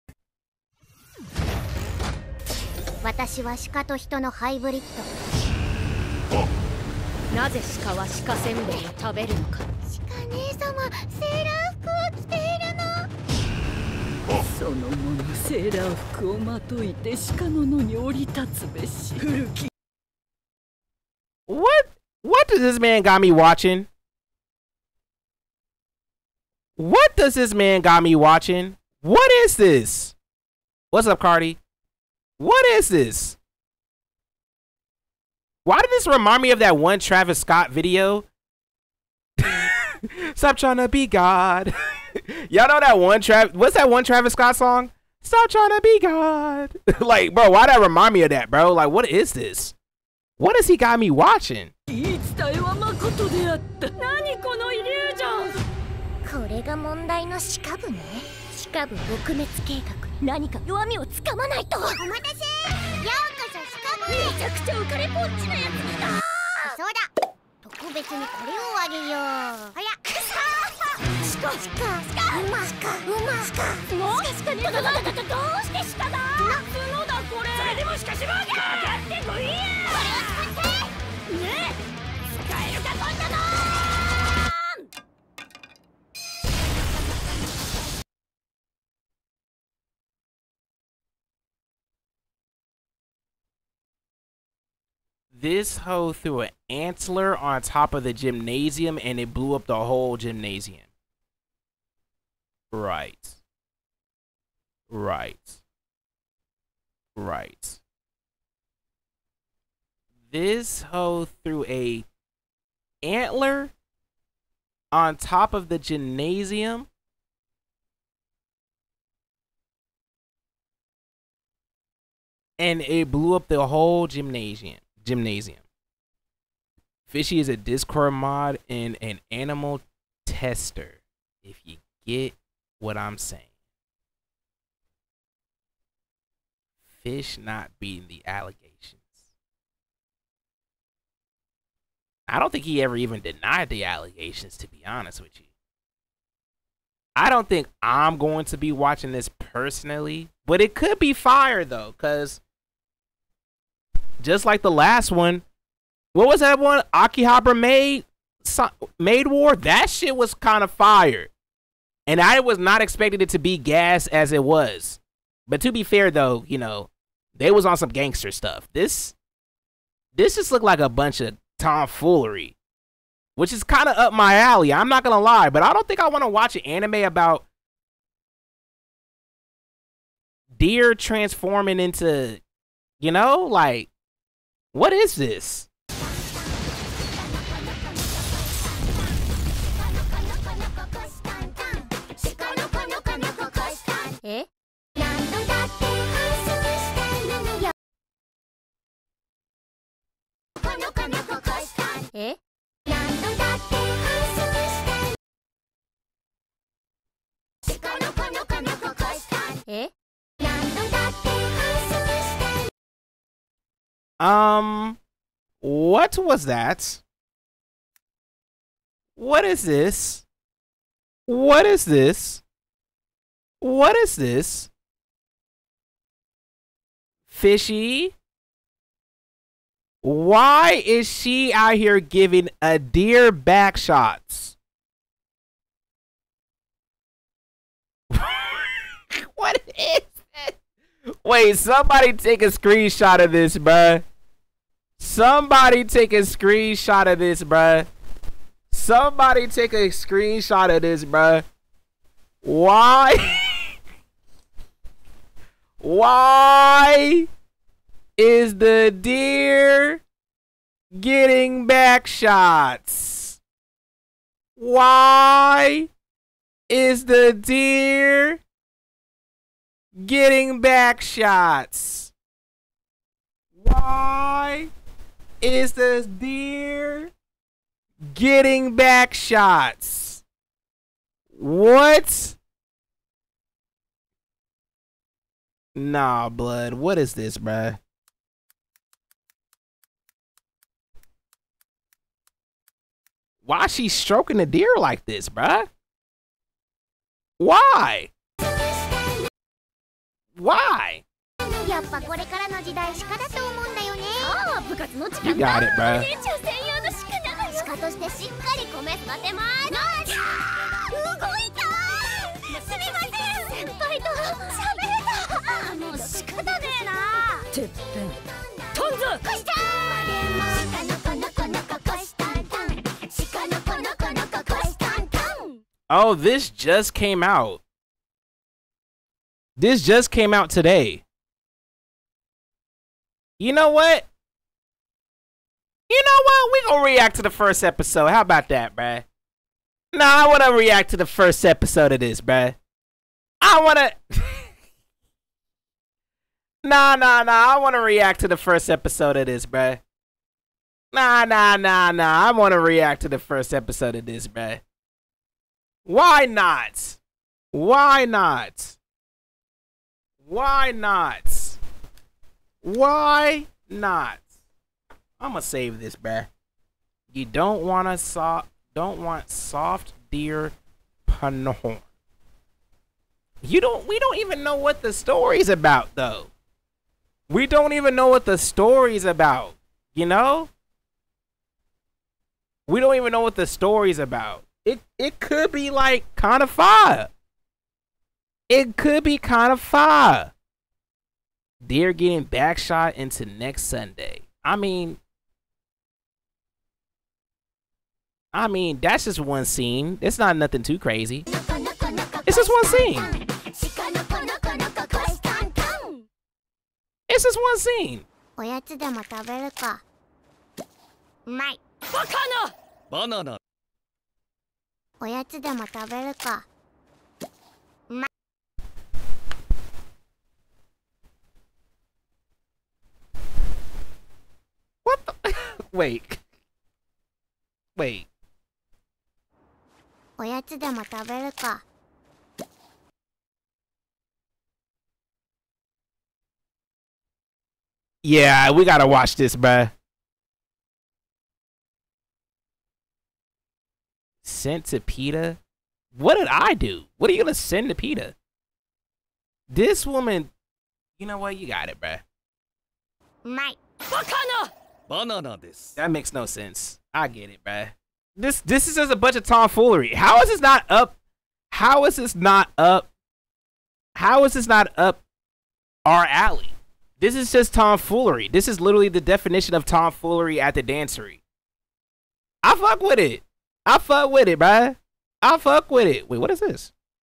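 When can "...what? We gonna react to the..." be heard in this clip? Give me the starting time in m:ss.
5:36.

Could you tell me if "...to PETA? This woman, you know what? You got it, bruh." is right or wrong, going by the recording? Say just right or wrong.
right.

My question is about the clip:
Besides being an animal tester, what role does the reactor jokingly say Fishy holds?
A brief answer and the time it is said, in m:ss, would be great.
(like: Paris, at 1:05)
Discord mod, at 2:07.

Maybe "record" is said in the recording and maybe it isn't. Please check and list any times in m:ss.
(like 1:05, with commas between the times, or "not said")
not said.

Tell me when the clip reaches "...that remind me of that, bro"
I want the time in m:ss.
0:47.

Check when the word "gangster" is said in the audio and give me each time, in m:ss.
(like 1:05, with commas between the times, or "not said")
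2:47.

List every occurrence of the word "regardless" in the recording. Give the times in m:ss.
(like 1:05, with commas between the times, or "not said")
not said.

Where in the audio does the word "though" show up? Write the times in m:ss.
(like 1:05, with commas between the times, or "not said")
2:31, 2:46, 6:15.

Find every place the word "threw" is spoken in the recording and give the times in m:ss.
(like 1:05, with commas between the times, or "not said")
1:36, 1:51.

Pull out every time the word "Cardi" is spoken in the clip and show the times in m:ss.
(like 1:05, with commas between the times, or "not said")
0:31.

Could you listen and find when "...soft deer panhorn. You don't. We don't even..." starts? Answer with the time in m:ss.
6:09.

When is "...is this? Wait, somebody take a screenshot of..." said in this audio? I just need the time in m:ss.
3:59.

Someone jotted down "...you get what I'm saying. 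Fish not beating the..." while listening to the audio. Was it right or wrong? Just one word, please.
right.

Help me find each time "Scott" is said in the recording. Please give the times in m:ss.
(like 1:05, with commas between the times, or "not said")
0:37, 0:44.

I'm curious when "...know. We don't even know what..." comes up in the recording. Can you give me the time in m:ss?
6:20.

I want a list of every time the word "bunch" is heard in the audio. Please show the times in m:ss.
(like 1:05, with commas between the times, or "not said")
2:50, 7:38.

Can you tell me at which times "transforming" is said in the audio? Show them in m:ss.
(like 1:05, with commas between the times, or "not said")
3:00.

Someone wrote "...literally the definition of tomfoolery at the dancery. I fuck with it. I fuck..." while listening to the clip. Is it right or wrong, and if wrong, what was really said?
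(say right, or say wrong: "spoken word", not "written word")
right.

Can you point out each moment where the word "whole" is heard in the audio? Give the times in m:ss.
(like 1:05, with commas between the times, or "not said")
1:39, 2:03.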